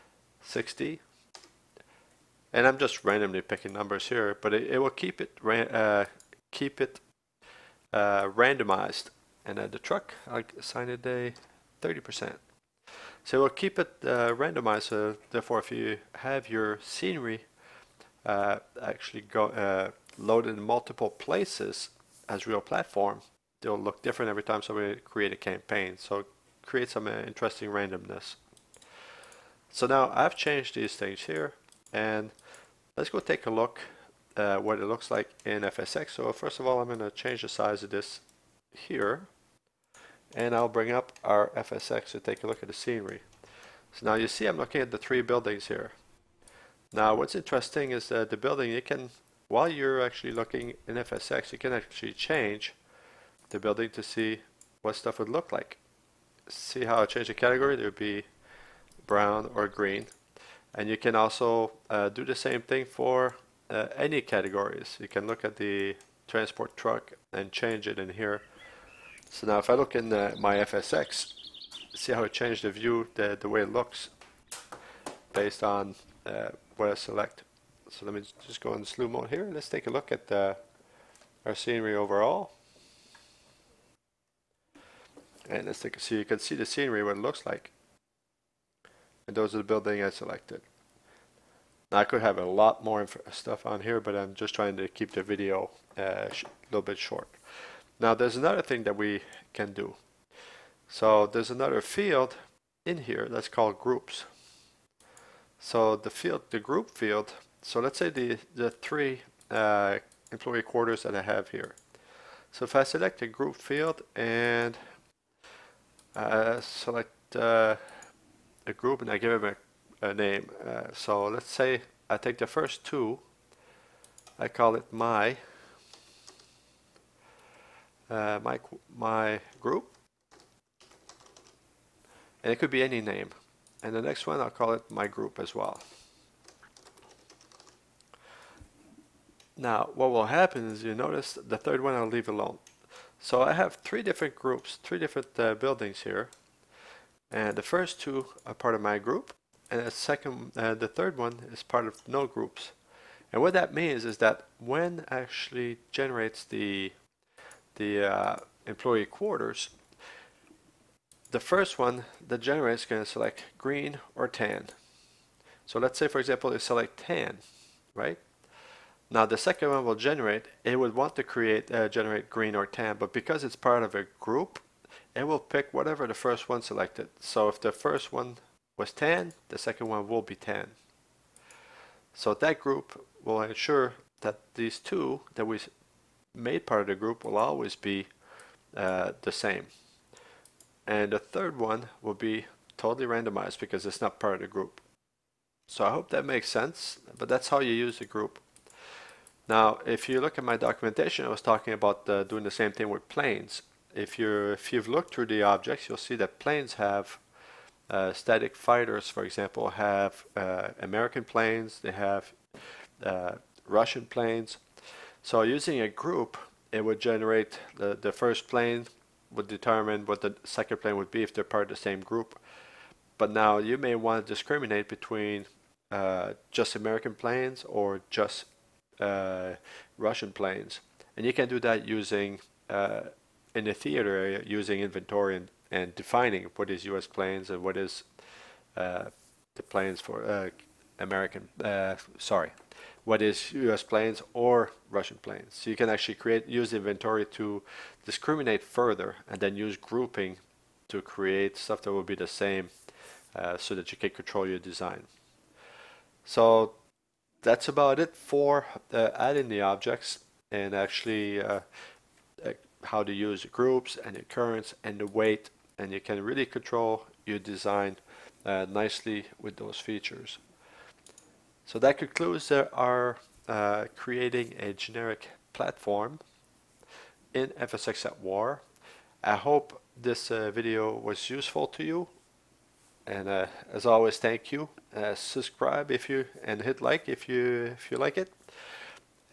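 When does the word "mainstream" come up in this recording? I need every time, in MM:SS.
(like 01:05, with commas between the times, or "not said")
not said.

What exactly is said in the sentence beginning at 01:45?
So the field, the group field, so let's say the, the three uh, employee quarters that I have here.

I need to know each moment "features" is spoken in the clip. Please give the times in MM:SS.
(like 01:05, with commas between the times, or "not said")
04:29.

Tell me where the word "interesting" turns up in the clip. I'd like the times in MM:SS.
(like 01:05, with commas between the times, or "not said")
00:27, 00:47.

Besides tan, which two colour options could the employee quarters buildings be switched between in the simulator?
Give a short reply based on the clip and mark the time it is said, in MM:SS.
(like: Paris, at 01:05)
Brown or green, at 00:59.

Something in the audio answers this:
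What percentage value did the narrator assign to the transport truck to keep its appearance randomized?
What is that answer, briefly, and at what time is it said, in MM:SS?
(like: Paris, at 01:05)
30%, at 00:11.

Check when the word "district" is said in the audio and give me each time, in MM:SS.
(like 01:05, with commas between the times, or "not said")
not said.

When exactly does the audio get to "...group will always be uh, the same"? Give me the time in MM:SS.
03:06.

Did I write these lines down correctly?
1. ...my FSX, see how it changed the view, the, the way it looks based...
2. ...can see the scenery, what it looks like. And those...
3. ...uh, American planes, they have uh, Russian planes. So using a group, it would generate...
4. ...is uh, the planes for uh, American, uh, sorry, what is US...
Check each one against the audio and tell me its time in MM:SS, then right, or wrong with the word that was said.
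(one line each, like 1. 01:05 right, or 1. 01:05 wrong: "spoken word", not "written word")
1. 01:10 right
2. 01:26 right
3. 03:30 right
4. 03:57 right.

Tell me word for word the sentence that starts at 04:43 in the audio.
And uh, as always, thank you.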